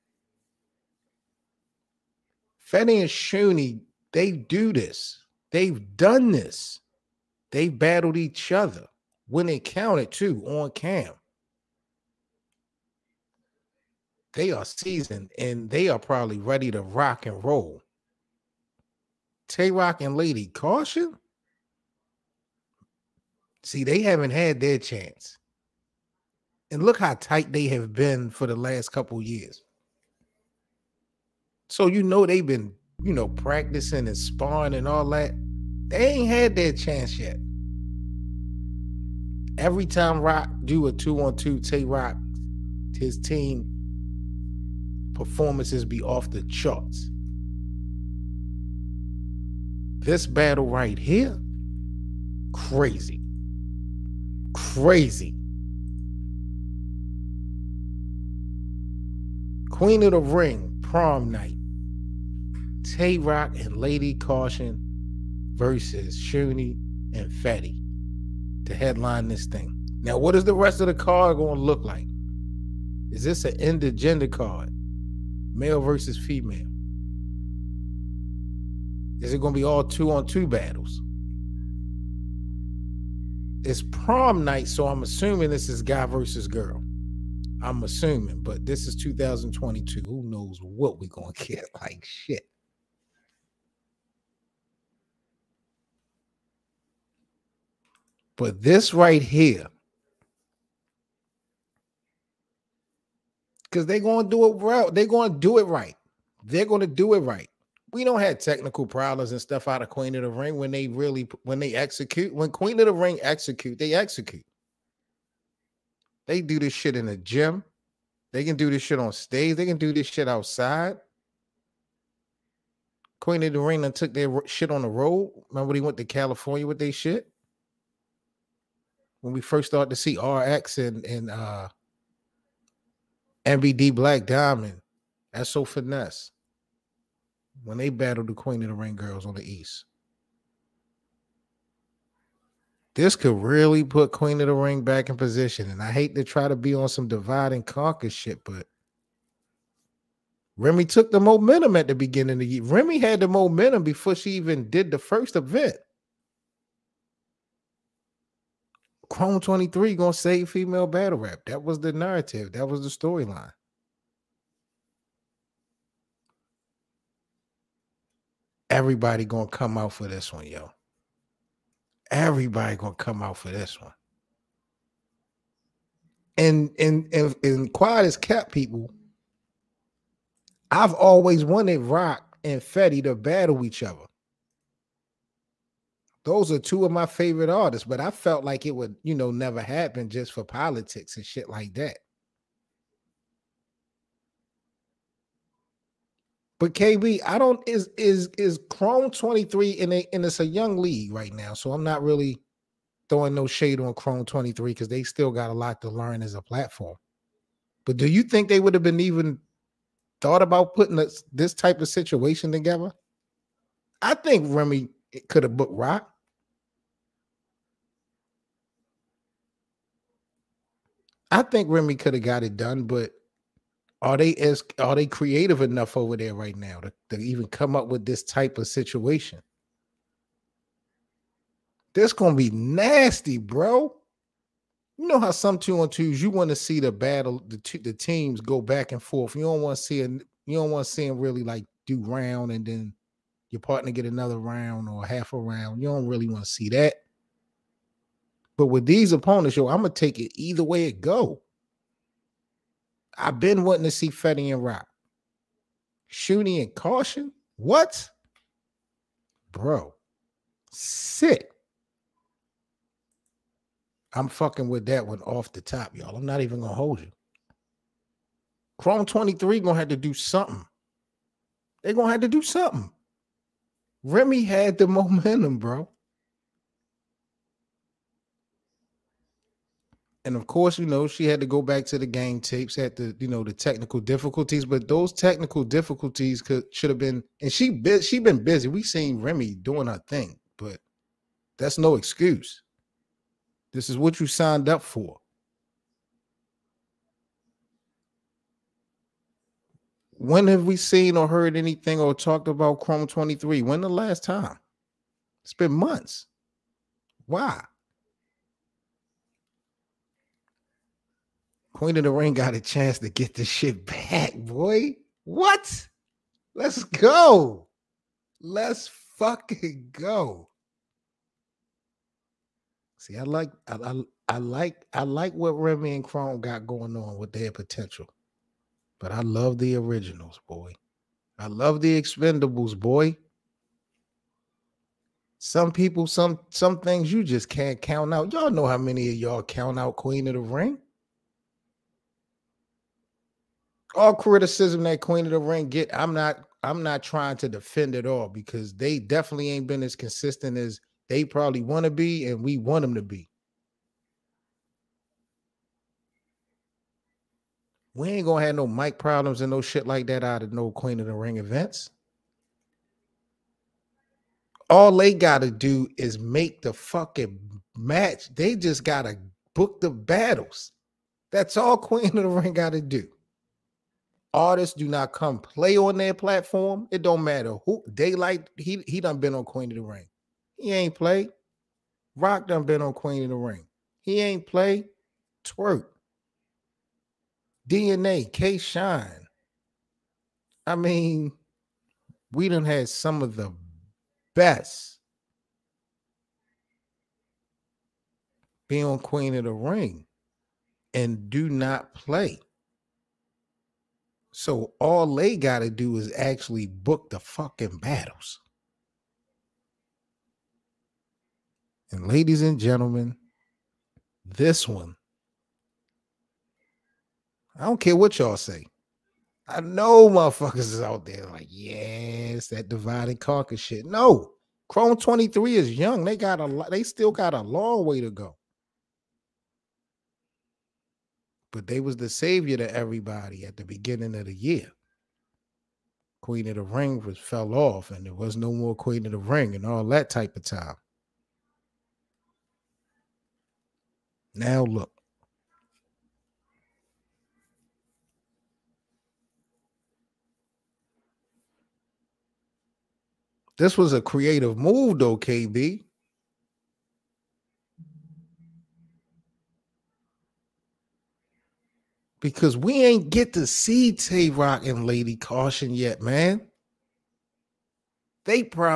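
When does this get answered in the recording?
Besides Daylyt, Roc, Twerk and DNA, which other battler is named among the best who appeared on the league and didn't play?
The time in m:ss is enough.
6:28.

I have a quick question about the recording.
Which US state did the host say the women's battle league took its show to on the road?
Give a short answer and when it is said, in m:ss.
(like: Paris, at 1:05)
California, at 2:06.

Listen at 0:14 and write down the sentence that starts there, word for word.
They are seasoned and they are probably ready to rock and roll.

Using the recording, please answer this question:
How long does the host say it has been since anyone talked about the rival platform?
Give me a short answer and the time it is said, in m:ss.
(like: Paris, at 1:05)
Months, at 5:05.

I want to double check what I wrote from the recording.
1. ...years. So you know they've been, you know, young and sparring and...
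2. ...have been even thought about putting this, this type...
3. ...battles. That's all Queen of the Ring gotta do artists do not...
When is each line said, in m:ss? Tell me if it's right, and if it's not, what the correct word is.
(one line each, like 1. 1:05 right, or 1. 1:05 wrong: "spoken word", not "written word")
1. 0:29 wrong: "practicing", not "young"
2. 3:28 right
3. 6:09 right.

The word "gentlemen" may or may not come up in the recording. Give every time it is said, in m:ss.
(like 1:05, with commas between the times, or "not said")
6:52.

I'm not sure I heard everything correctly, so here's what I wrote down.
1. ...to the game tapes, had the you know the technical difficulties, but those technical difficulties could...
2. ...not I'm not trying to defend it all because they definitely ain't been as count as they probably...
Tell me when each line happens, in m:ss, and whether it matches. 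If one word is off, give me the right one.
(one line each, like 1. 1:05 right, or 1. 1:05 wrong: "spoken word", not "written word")
1. 4:41 right
2. 5:46 wrong: "consistent", not "count".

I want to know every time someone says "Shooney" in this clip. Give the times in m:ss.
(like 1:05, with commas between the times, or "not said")
0:03, 1:06, 4:16.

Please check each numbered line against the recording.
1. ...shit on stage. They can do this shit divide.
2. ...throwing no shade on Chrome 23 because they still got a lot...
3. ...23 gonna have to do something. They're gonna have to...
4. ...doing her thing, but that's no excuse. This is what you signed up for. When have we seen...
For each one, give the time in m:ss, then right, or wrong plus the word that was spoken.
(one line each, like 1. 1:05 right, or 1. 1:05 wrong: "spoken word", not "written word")
1. 1:58 wrong: "outside", not "divide"
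2. 3:23 right
3. 4:29 right
4. 4:49 right.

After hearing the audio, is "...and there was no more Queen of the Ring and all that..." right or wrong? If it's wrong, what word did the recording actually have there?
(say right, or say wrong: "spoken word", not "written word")
right.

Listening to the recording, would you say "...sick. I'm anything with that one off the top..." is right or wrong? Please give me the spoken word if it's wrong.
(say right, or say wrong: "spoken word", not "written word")
wrong: "fucking", not "anything".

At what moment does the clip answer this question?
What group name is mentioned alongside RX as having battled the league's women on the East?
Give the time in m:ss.
2:13.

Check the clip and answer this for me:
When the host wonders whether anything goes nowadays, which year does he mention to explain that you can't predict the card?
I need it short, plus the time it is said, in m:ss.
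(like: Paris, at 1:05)
2022, at 1:28.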